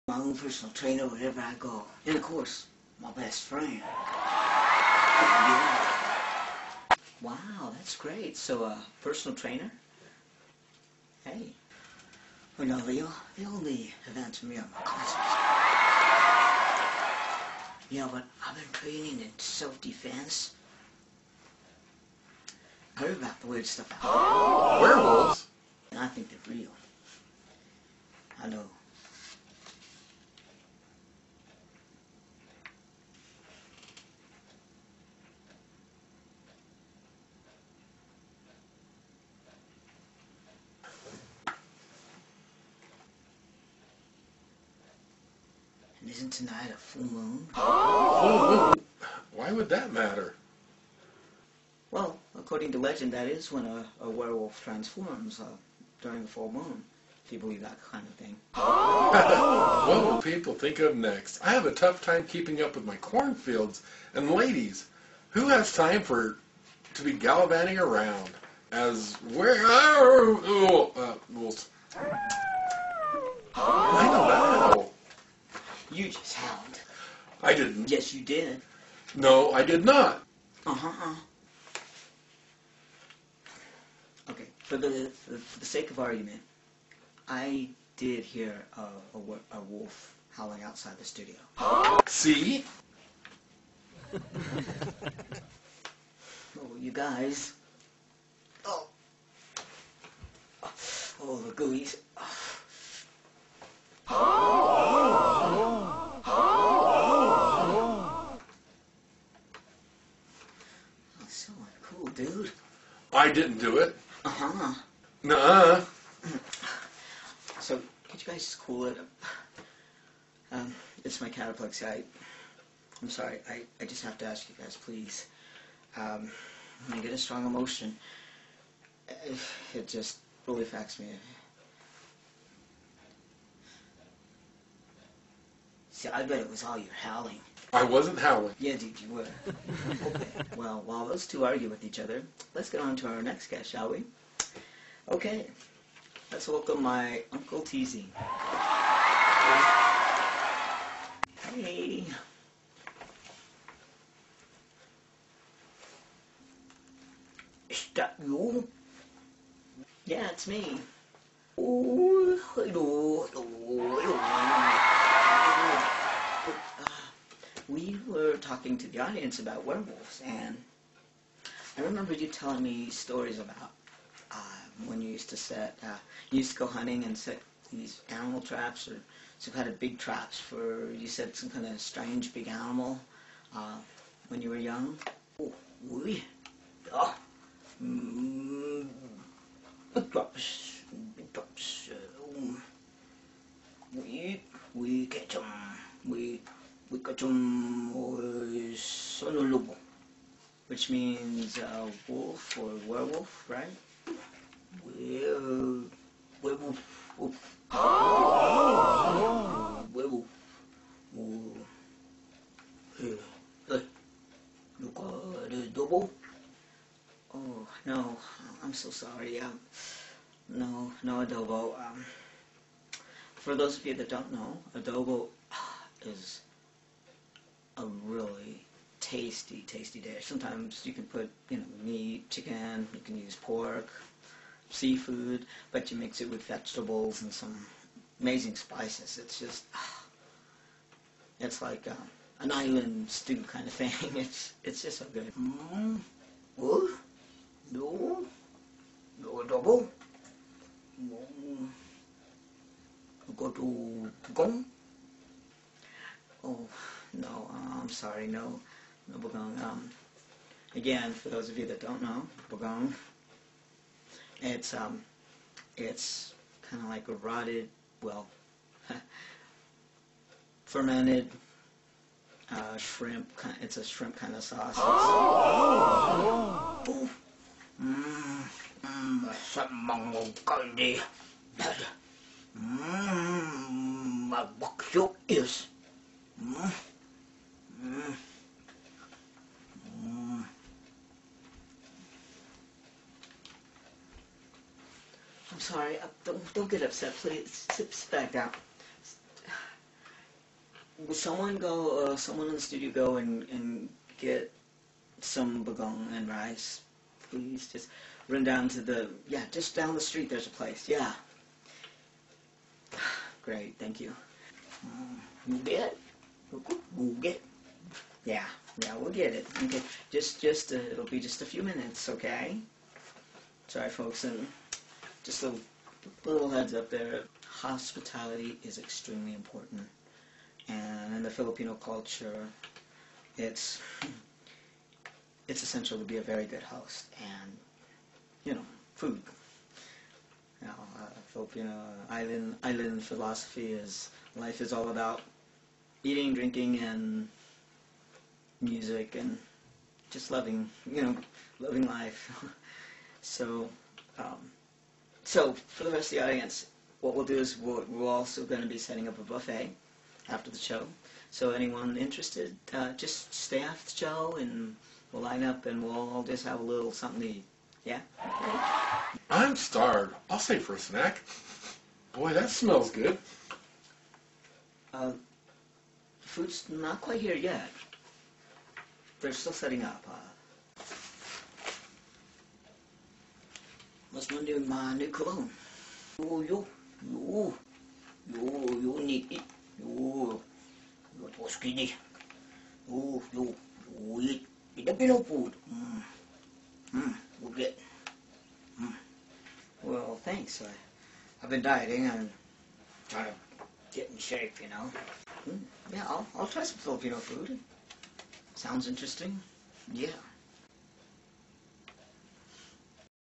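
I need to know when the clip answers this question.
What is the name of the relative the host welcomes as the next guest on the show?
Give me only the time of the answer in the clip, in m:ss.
2:27.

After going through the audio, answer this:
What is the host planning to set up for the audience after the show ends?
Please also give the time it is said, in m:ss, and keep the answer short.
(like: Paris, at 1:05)
A buffet, at 5:59.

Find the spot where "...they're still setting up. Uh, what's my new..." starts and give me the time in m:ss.
6:19.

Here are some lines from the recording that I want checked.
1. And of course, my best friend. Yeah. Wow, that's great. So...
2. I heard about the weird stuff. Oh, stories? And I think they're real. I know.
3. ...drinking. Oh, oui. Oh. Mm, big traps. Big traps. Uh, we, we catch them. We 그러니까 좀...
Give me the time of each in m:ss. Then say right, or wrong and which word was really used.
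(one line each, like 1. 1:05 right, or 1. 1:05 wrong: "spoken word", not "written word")
1. 0:02 right
2. 0:22 wrong: "werewolves", not "stories"
3. 3:04 wrong: "young", not "drinking".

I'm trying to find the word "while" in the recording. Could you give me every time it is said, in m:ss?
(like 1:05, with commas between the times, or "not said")
2:20.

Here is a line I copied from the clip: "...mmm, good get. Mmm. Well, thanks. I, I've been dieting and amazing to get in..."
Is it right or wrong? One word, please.
wrong.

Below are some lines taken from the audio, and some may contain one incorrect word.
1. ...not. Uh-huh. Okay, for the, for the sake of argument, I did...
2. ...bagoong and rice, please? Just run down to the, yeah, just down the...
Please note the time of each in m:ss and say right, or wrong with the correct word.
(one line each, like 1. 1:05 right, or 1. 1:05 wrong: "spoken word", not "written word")
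1. 1:19 right
2. 5:05 right.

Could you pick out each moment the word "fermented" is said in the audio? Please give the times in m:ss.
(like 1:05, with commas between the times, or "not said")
4:30.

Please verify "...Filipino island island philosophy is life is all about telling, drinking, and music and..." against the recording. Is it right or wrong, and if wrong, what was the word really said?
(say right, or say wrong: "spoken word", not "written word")
wrong: "eating", not "telling".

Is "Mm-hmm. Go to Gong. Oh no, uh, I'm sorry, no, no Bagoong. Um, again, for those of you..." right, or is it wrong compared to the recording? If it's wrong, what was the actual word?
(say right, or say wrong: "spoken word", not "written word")
right.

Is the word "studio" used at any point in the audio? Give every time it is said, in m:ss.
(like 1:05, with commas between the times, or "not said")
1:31, 5:02.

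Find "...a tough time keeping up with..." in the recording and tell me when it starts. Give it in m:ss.
1:01.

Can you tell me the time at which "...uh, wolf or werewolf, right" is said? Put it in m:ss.
3:21.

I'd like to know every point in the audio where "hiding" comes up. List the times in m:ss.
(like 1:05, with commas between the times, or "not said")
not said.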